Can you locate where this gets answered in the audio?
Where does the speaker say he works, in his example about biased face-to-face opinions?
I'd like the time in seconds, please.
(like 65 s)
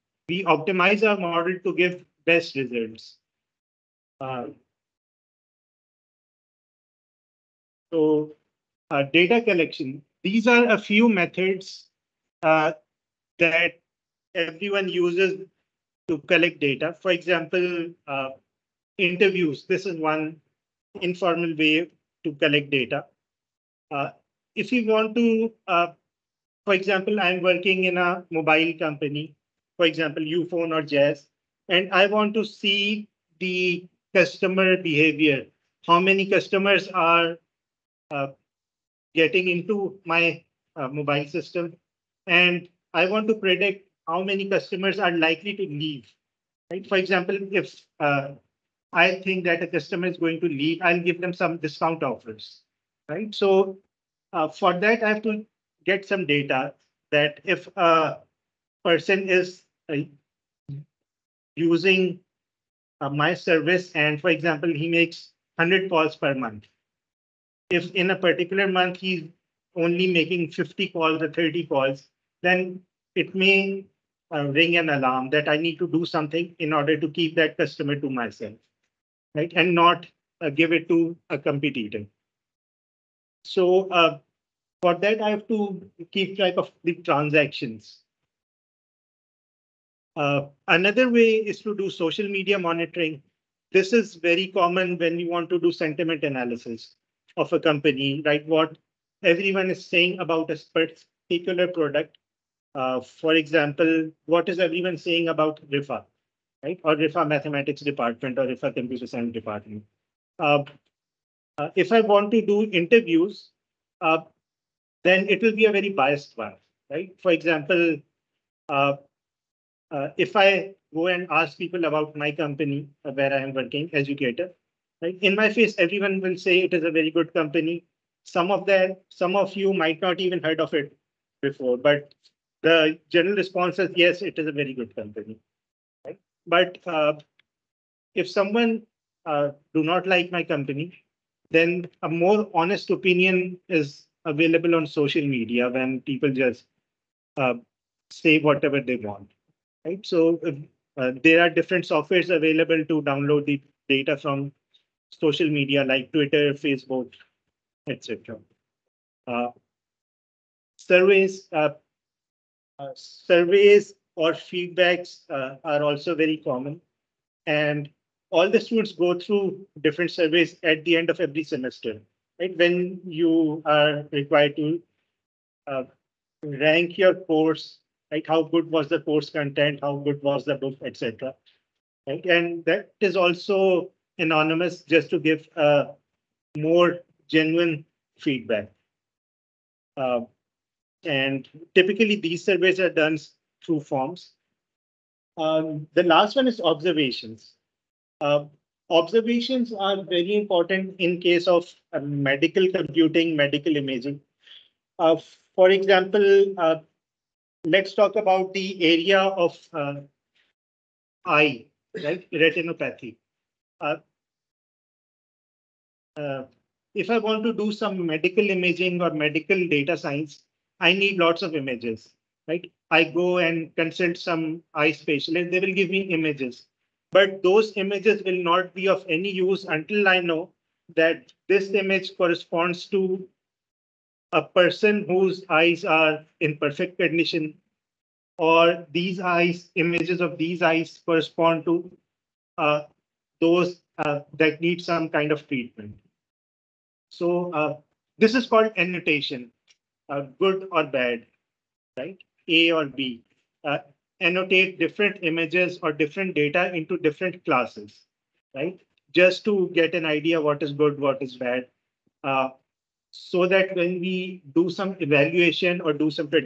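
123 s.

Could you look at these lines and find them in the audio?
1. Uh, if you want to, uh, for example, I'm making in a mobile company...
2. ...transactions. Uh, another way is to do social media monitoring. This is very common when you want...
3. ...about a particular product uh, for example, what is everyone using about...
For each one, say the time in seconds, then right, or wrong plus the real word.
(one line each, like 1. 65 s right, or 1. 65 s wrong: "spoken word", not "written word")
1. 23 s wrong: "working", not "making"
2. 86 s right
3. 100 s wrong: "saying", not "using".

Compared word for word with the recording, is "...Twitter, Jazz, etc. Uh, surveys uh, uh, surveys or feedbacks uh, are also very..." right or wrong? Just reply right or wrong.
wrong.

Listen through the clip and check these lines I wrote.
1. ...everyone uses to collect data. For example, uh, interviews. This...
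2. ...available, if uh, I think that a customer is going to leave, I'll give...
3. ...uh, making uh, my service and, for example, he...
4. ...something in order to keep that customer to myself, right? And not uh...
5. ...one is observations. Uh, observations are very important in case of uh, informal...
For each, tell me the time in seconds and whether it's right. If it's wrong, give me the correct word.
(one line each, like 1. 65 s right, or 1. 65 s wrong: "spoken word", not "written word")
1. 14 s right
2. 46 s wrong: "example", not "available"
3. 59 s wrong: "using", not "making"
4. 76 s right
5. 196 s wrong: "medical", not "informal".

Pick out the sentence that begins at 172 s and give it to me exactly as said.
When you are required to uh, rank your course, like how good was the course content, how good was the book, etc.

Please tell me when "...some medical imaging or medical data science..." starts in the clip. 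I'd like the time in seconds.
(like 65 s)
217 s.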